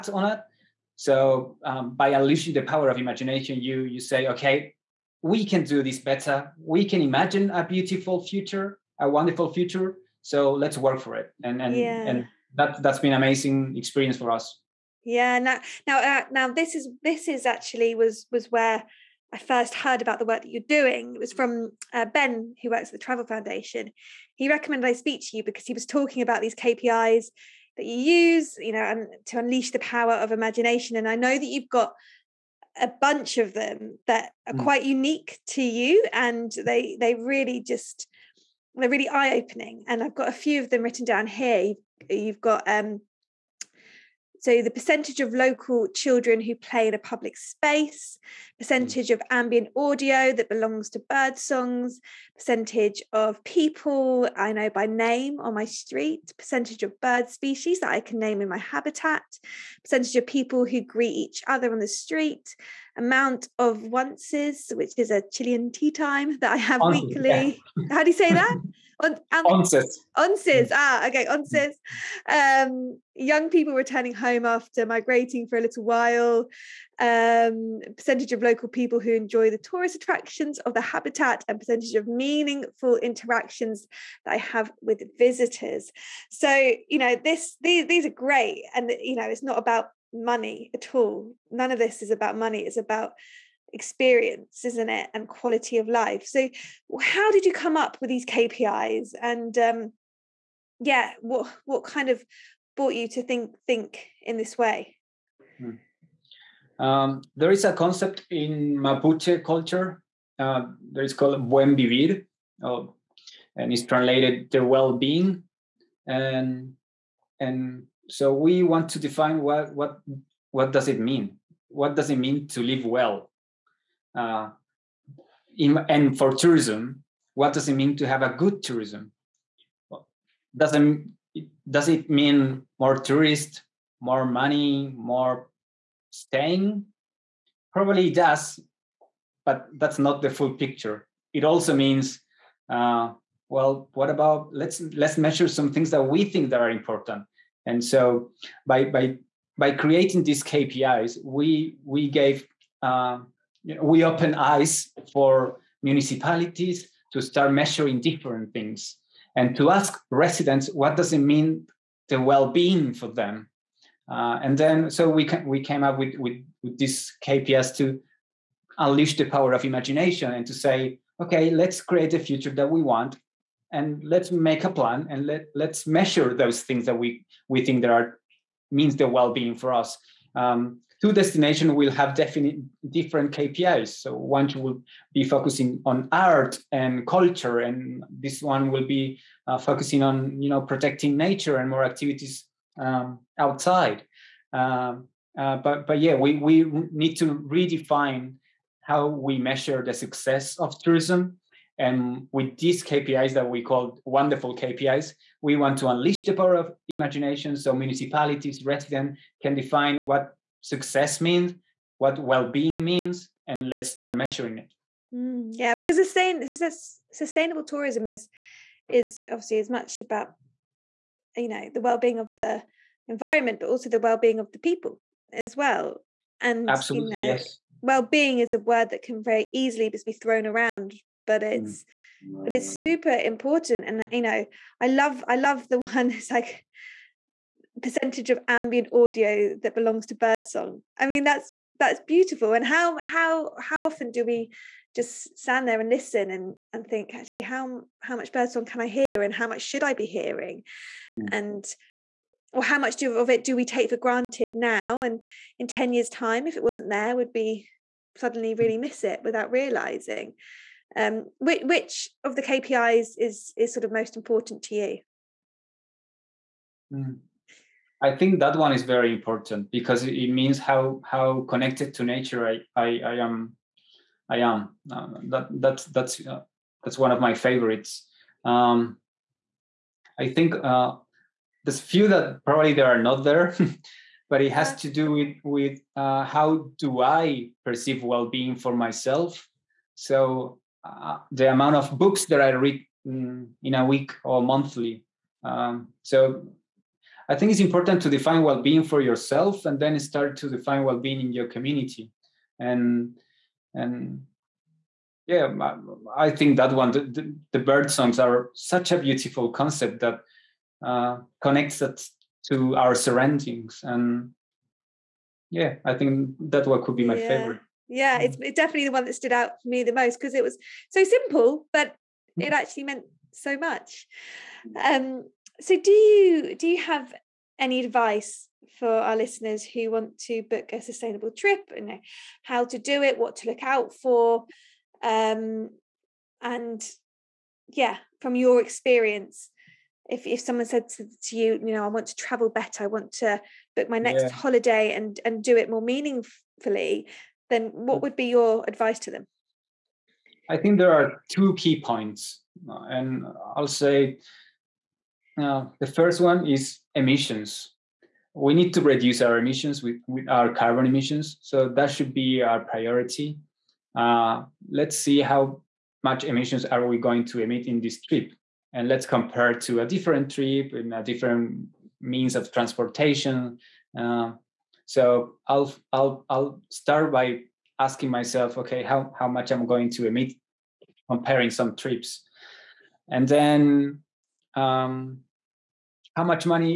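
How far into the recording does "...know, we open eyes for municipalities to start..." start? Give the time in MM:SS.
02:33.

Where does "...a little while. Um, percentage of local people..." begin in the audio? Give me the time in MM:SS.
01:15.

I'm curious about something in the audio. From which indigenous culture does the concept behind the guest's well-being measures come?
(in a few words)
Mapuche.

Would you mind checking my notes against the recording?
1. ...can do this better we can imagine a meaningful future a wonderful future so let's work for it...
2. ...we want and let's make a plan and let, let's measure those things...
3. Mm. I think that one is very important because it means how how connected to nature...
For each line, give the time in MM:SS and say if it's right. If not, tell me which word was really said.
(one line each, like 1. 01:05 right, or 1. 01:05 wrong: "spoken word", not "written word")
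1. 00:05 wrong: "beautiful", not "meaningful"
2. 02:52 right
3. 04:26 right.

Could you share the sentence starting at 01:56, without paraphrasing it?
And and so we want to define what what what does it mean?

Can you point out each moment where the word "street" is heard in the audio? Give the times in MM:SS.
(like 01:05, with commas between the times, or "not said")
00:55, 01:01.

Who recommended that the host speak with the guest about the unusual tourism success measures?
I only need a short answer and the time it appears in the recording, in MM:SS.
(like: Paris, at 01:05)
Ben, at 00:22.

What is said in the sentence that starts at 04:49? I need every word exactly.
So the amount of books that I read in, mm, in a week or monthly.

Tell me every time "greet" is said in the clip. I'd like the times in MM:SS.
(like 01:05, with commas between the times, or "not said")
01:00.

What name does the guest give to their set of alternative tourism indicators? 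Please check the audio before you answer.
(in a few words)
wonderful KPIs.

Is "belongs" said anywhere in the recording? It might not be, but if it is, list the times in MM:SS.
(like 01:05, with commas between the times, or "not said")
00:50, 03:59.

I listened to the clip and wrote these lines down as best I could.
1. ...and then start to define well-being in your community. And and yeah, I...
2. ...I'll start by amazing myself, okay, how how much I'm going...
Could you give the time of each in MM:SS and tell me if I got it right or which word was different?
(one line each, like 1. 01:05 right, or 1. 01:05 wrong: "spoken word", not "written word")
1. 04:59 right
2. 06:16 wrong: "asking", not "amazing".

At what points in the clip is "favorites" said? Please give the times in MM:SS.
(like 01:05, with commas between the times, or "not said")
04:37, 05:17.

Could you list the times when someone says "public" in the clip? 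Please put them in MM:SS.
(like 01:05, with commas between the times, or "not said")
00:46.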